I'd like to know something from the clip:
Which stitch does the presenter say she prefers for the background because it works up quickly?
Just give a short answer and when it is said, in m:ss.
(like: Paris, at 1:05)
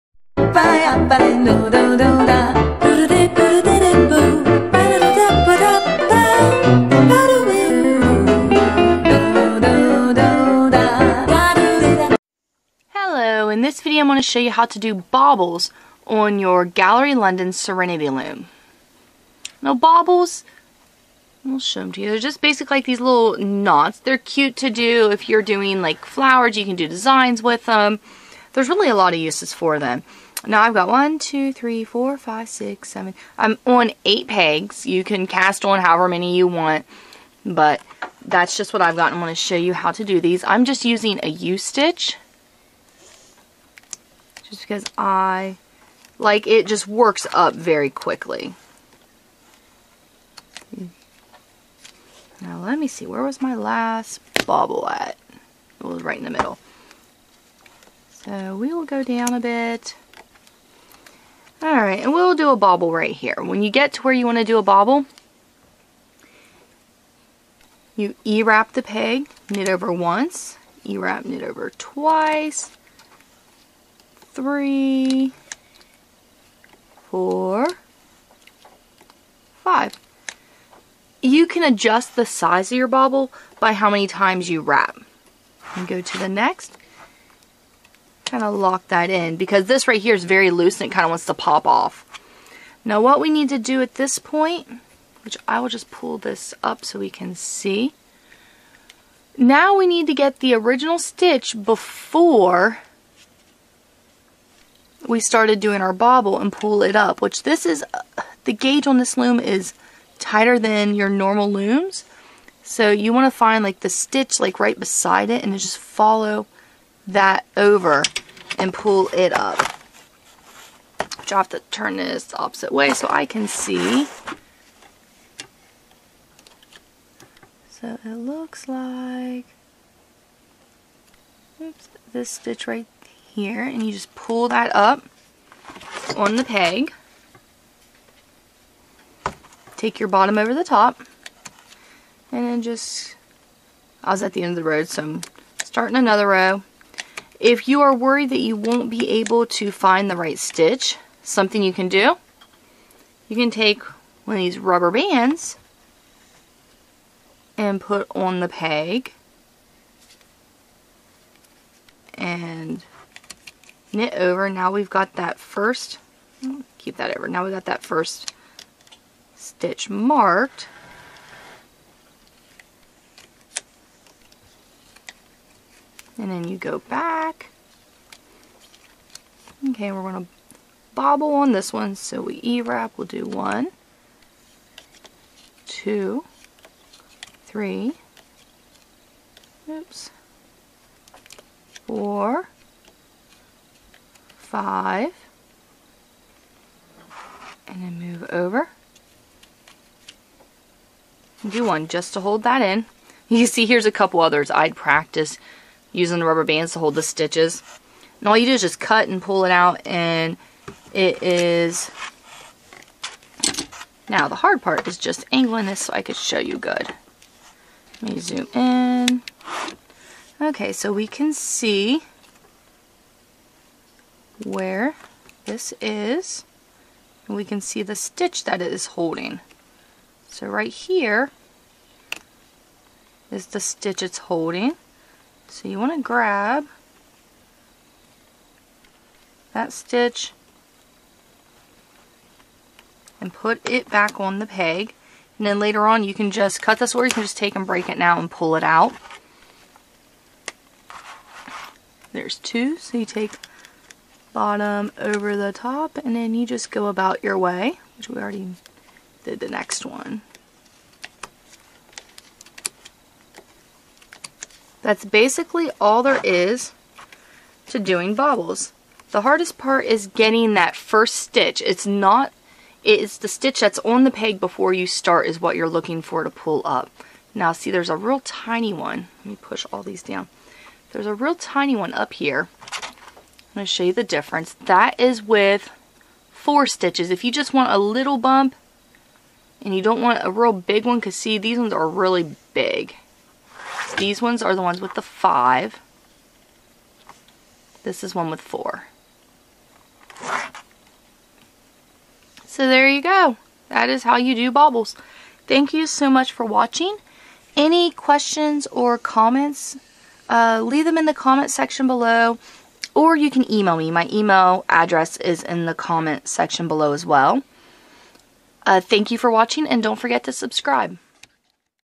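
U-stitch, at 0:41.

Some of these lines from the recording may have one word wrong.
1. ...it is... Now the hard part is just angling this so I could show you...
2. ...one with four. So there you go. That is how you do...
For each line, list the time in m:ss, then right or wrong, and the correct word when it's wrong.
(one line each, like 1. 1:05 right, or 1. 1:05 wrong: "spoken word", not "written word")
1. 3:30 right
2. 4:58 right.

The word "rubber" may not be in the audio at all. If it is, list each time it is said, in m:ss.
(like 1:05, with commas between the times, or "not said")
2:34, 3:26.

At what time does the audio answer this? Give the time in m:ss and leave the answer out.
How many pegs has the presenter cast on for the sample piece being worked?
0:34.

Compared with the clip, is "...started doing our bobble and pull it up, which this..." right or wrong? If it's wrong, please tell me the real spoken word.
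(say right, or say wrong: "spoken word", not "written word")
right.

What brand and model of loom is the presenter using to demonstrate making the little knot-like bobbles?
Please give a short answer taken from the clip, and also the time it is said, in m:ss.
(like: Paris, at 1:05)
Gallery London Serenity Loom, at 0:16.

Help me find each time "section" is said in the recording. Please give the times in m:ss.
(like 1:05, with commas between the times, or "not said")
5:11, 5:16.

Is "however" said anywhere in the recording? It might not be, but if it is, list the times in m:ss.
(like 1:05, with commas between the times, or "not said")
0:35.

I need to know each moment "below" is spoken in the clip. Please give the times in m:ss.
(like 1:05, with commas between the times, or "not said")
5:11, 5:16.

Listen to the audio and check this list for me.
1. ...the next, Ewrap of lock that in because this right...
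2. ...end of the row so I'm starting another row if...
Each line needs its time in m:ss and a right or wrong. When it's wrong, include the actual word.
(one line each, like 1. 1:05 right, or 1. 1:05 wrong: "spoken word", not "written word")
1. 1:26 wrong: "Kind", not "Ewrap"
2. 2:24 right.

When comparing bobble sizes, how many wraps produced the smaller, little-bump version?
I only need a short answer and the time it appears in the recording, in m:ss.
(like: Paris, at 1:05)
4, at 4:46.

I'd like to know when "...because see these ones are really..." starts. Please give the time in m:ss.
4:50.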